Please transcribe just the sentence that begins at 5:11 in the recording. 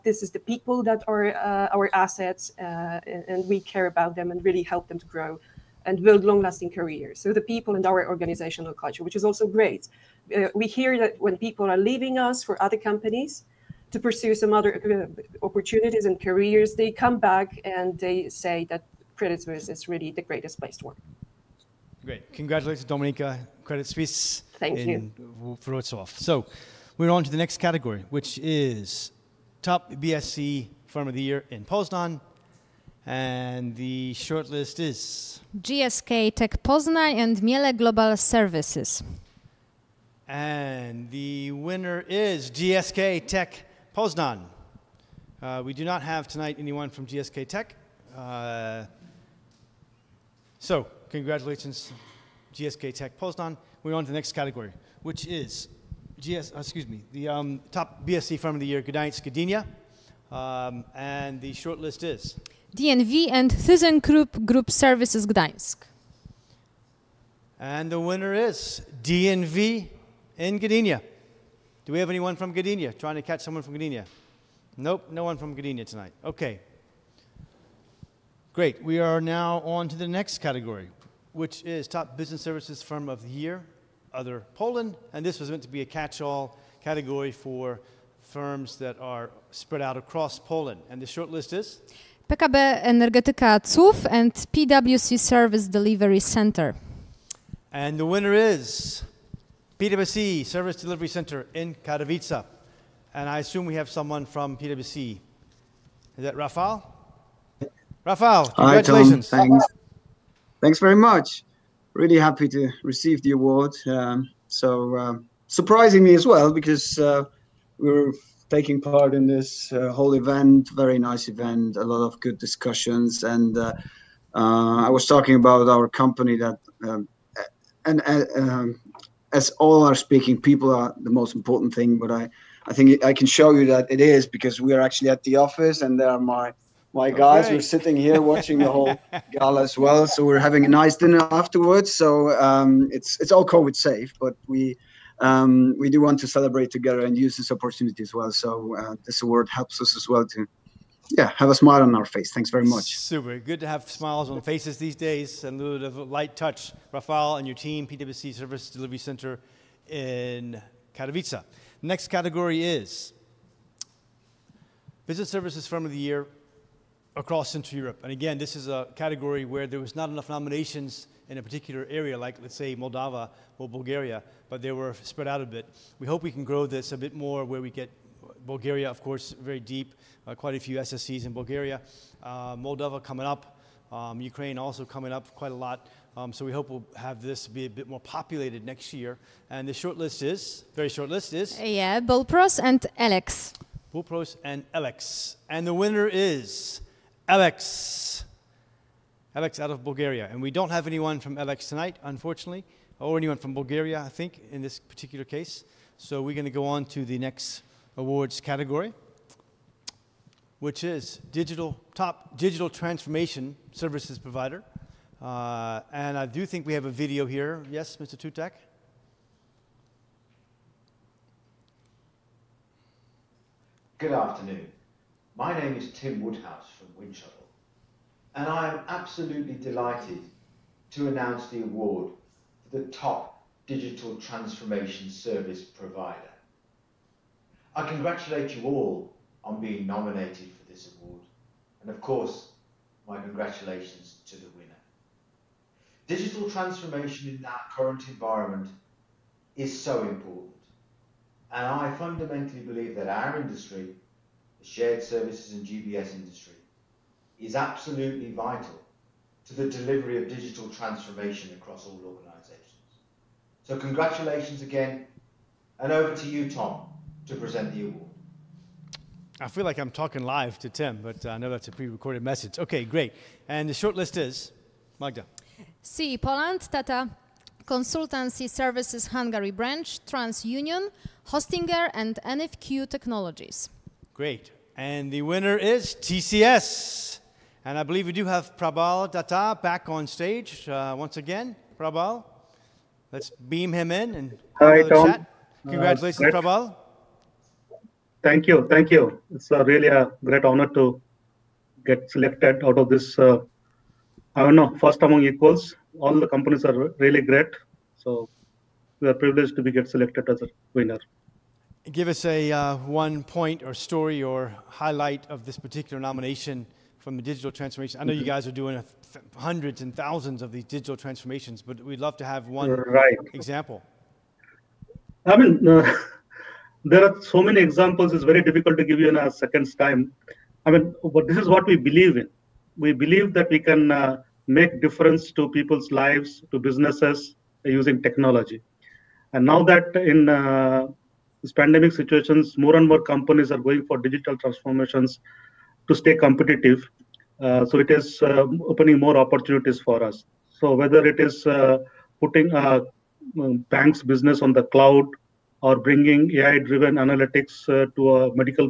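Give us a uh, one point or story or highlight of this particular nomination from the digital transformation?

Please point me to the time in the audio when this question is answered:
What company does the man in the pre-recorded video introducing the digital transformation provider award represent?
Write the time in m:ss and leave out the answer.
3:46.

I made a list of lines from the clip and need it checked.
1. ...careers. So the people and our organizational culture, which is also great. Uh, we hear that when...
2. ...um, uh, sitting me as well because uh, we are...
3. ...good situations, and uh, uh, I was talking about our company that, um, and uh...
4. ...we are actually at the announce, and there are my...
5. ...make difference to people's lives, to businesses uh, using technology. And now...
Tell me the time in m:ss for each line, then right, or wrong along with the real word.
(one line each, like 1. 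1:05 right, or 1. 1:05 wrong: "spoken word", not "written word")
1. 0:06 right
2. 1:54 wrong: "surprising", not "sitting"
3. 2:02 wrong: "discussions", not "situations"
4. 2:14 wrong: "office", not "announce"
5. 5:34 right.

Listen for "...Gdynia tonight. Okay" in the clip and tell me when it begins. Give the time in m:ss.
1:15.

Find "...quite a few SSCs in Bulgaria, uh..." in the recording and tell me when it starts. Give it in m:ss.
3:00.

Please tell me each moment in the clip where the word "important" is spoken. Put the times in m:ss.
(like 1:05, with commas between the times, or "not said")
2:11, 4:10.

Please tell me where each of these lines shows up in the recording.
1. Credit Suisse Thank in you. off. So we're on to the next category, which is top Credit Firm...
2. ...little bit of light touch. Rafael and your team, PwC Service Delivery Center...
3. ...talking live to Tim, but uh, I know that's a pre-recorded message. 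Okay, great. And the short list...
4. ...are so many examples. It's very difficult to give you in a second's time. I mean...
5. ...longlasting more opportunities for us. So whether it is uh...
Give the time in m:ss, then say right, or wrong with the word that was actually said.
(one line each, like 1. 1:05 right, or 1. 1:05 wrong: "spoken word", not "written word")
1. 0:23 wrong: "BSC", not "Credit"
2. 2:35 right
3. 4:29 right
4. 5:27 right
5. 5:48 wrong: "opening", not "longlasting".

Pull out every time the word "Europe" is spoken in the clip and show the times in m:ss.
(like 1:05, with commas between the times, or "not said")
2:47.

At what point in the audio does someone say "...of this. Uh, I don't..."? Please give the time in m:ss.
5:02.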